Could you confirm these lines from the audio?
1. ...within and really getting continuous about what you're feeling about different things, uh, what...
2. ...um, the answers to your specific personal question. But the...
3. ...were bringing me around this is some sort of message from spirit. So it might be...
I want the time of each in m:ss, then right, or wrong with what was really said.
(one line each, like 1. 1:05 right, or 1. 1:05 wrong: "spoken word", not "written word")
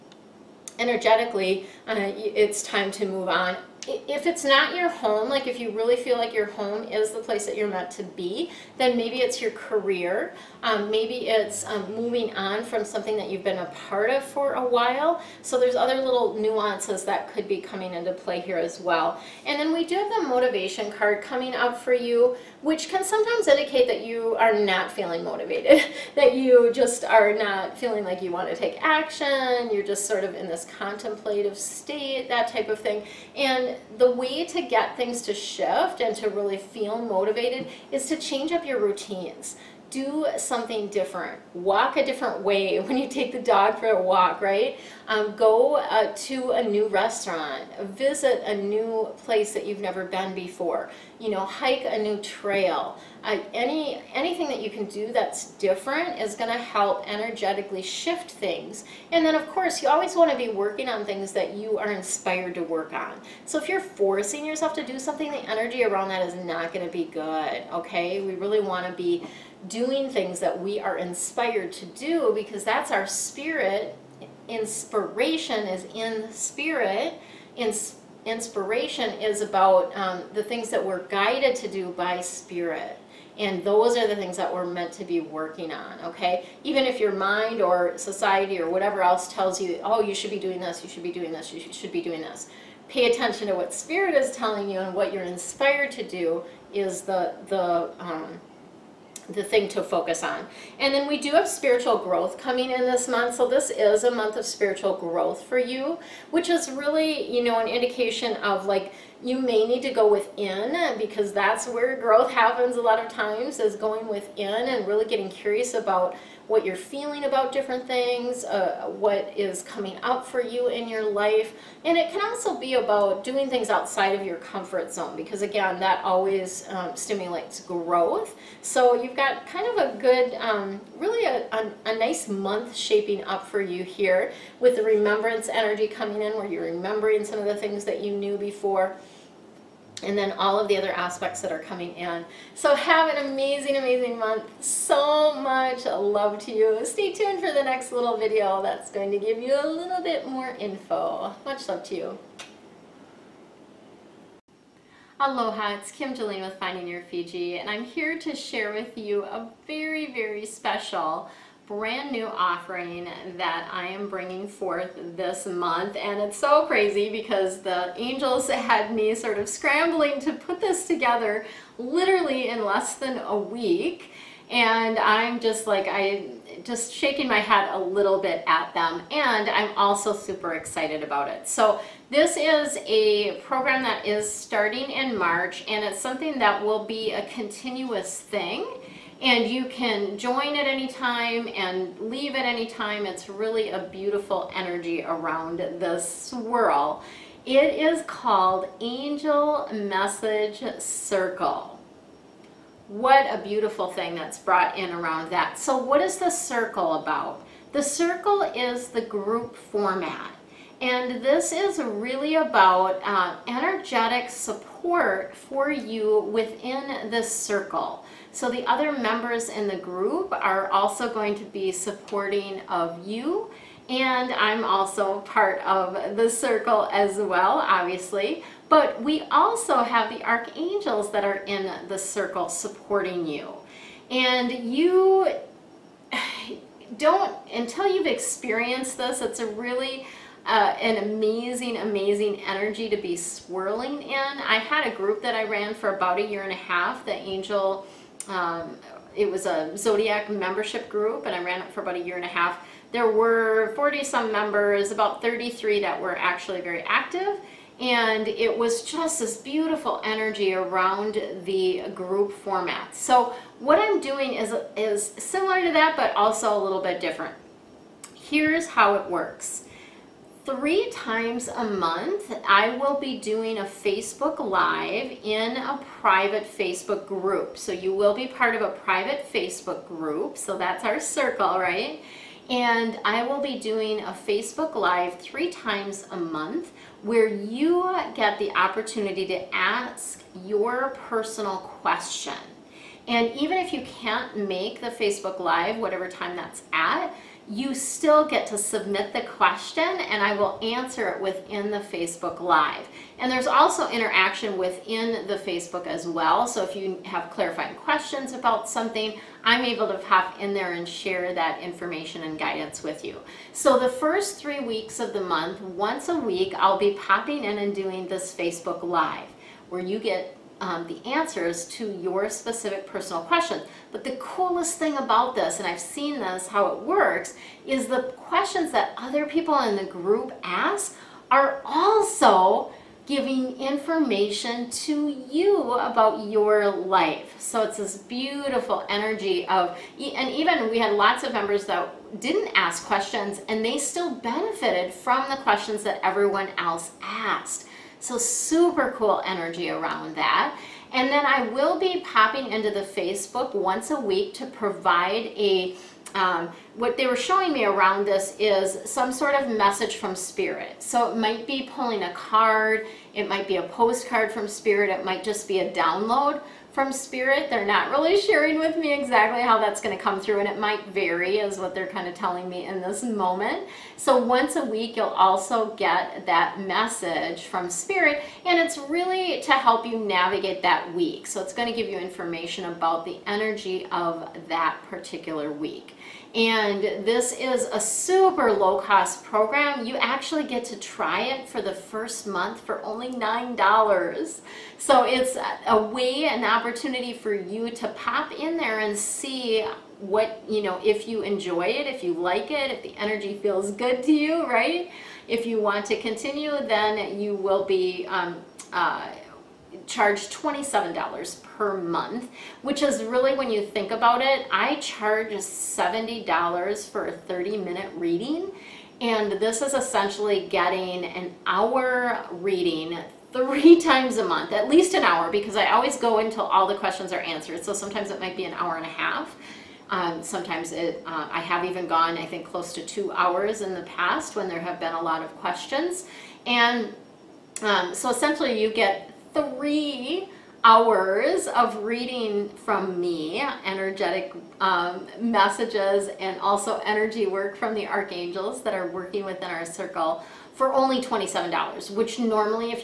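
1. 1:54 wrong: "curious", not "continuous"
2. 5:20 right
3. 5:57 wrong: "showing", not "bringing".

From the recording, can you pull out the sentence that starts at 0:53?
Uh, any anything that you can do that's different is going to help energetically shift things.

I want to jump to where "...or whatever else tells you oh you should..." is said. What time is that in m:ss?
1:28.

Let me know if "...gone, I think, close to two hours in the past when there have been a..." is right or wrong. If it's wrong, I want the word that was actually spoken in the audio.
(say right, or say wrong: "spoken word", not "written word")
right.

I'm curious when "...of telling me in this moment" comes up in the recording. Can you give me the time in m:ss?
6:12.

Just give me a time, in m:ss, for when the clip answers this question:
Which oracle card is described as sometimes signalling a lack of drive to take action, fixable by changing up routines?
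0:20.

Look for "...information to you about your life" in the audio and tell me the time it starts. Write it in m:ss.
5:33.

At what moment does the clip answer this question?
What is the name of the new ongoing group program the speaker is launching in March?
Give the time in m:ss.
3:18.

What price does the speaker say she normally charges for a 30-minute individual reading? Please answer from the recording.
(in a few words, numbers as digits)
$70.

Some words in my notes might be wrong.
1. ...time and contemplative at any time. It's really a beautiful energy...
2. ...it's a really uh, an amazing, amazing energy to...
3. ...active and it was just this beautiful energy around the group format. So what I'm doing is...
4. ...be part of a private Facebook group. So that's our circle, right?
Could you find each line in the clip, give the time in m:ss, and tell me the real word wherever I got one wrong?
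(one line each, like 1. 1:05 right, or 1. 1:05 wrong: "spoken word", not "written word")
1. 3:10 wrong: "leave", not "contemplative"
2. 3:59 right
3. 4:16 right
4. 4:38 right.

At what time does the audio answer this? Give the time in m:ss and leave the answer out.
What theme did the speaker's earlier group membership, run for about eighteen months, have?
4:09.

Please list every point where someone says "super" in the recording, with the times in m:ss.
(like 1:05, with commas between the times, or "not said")
3:00, 5:48, 6:27.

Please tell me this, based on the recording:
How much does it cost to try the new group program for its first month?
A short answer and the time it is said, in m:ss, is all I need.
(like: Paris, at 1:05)
$9, at 6:33.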